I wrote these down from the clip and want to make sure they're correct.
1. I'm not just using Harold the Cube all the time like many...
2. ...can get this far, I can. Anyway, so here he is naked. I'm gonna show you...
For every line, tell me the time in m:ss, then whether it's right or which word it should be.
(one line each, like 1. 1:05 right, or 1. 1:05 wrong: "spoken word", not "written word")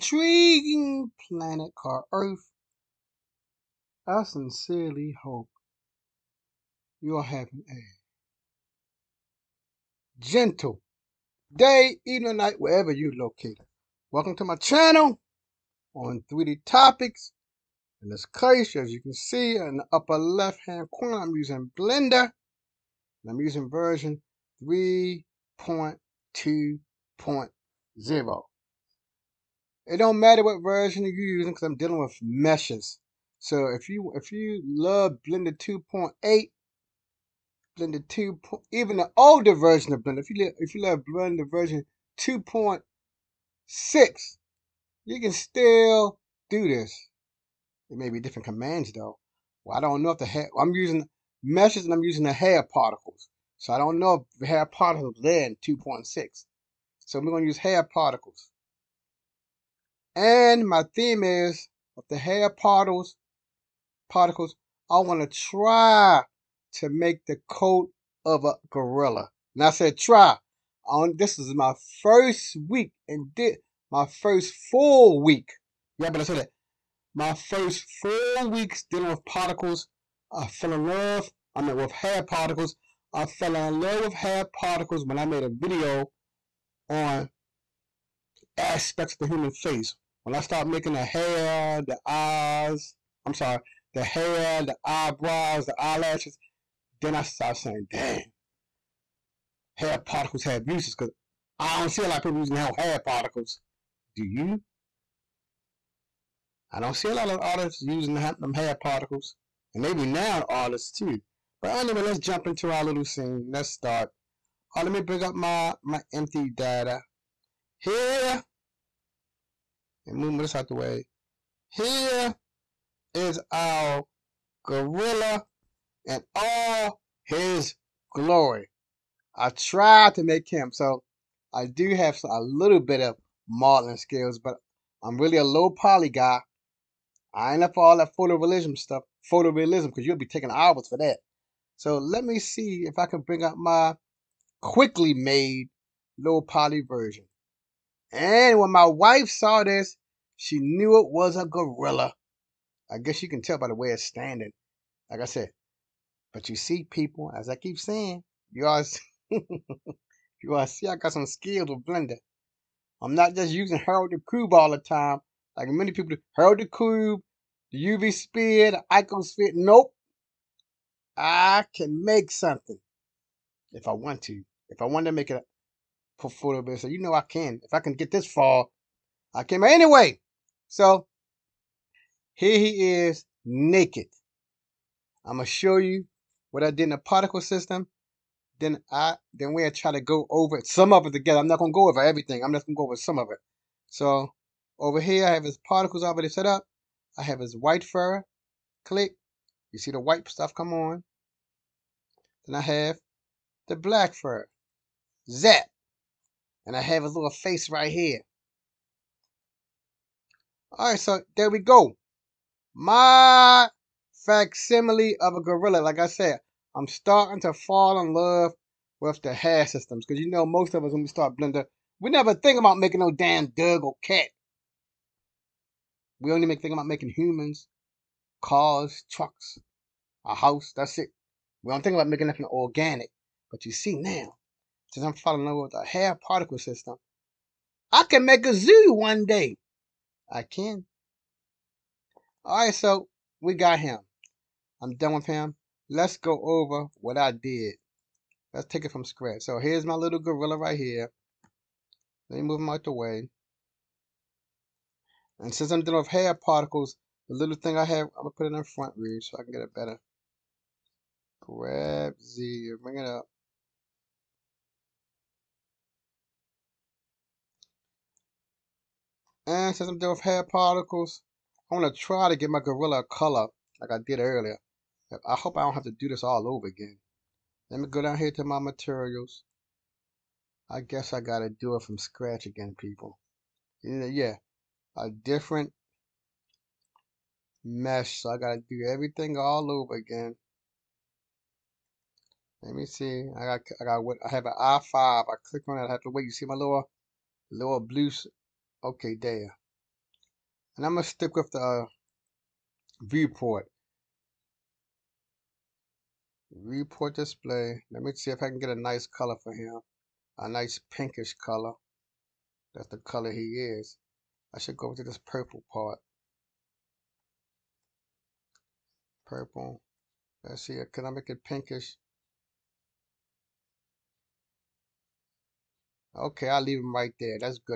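1. 2:43 right
2. 2:57 right.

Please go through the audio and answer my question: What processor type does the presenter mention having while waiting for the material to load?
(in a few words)
i5.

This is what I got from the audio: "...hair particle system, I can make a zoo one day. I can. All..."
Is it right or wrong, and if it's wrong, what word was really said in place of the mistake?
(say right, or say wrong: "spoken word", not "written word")
right.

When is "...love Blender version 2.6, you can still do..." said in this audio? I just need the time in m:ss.
0:40.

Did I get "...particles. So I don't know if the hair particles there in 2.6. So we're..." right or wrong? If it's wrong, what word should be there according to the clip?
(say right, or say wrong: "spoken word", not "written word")
right.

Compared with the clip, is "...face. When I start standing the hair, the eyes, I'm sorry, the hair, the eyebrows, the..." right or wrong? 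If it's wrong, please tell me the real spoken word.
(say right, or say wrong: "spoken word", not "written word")
wrong: "making", not "standing".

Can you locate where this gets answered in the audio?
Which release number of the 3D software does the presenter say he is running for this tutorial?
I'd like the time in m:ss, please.
0:24.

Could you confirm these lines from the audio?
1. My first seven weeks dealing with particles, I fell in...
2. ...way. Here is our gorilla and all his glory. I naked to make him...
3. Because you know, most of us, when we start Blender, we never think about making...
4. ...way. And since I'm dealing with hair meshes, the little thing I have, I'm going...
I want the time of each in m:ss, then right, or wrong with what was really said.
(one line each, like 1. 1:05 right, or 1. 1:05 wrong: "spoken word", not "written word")
1. 1:17 wrong: "four", not "seven"
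2. 2:00 wrong: "tried", not "naked"
3. 3:40 right
4. 4:12 wrong: "particles", not "meshes".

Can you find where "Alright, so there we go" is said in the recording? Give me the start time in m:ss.
3:30.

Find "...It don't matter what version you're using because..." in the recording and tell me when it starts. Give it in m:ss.
0:29.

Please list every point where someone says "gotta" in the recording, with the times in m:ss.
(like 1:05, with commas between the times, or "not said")
4:41, 4:48.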